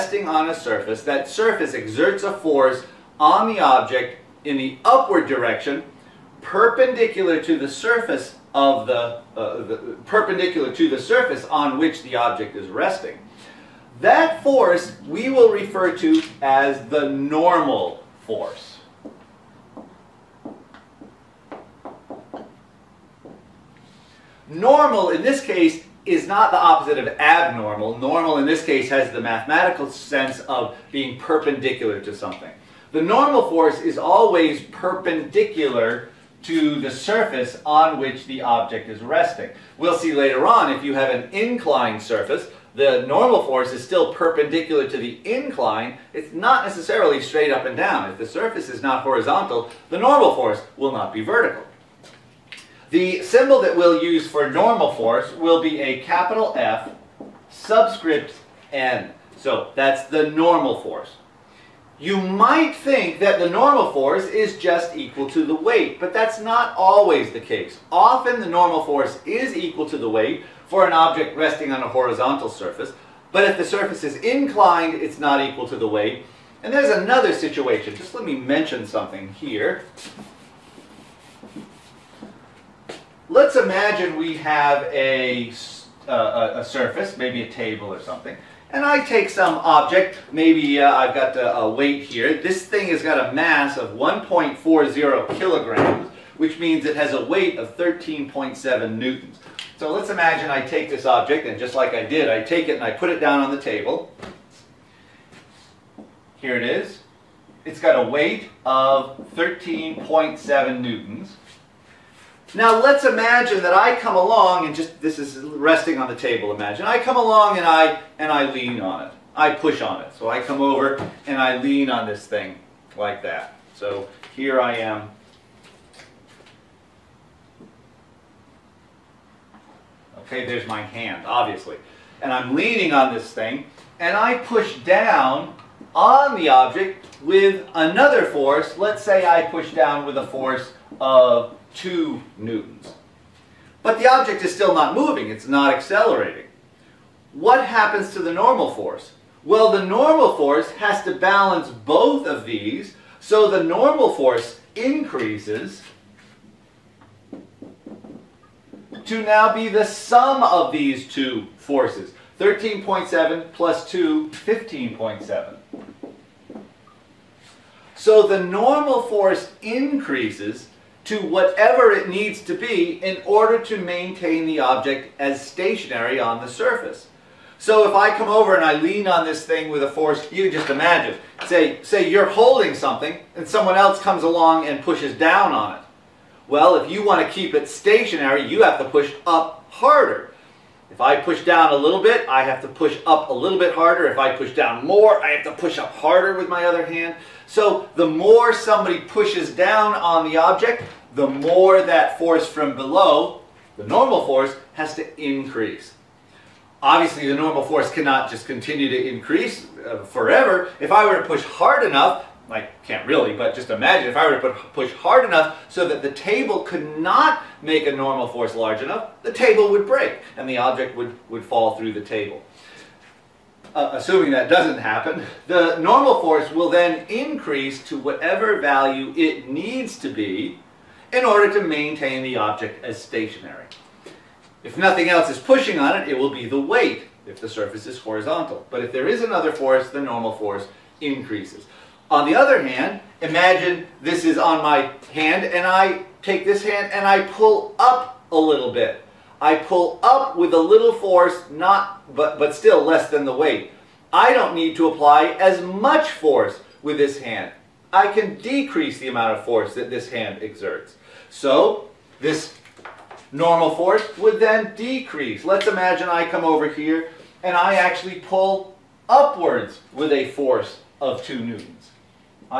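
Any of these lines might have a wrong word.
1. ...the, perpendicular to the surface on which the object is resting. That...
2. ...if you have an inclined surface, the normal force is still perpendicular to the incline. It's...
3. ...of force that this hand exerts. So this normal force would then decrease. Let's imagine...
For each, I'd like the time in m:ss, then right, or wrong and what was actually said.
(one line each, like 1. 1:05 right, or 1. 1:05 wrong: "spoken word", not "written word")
1. 0:09 right
2. 0:40 right
3. 4:19 right.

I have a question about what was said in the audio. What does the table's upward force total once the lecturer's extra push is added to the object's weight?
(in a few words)
15.7.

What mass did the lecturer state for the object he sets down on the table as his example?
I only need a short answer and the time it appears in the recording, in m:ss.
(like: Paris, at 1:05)
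1.40 kg, at 1:33.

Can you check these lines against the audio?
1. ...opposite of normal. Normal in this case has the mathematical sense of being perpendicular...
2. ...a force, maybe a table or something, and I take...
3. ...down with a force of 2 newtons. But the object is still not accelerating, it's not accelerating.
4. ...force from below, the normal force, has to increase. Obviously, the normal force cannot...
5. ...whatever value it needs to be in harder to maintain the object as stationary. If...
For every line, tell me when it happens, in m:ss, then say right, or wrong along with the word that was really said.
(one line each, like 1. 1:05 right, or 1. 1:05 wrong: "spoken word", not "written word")
1. 0:26 wrong: "abnormal", not "normal"
2. 1:26 wrong: "surface", not "force"
3. 2:19 wrong: "moving", not "accelerating"
4. 3:22 right
5. 3:47 wrong: "order", not "harder".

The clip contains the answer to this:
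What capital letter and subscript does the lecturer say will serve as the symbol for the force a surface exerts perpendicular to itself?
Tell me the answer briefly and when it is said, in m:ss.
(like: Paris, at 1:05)
F subscript N, at 0:56.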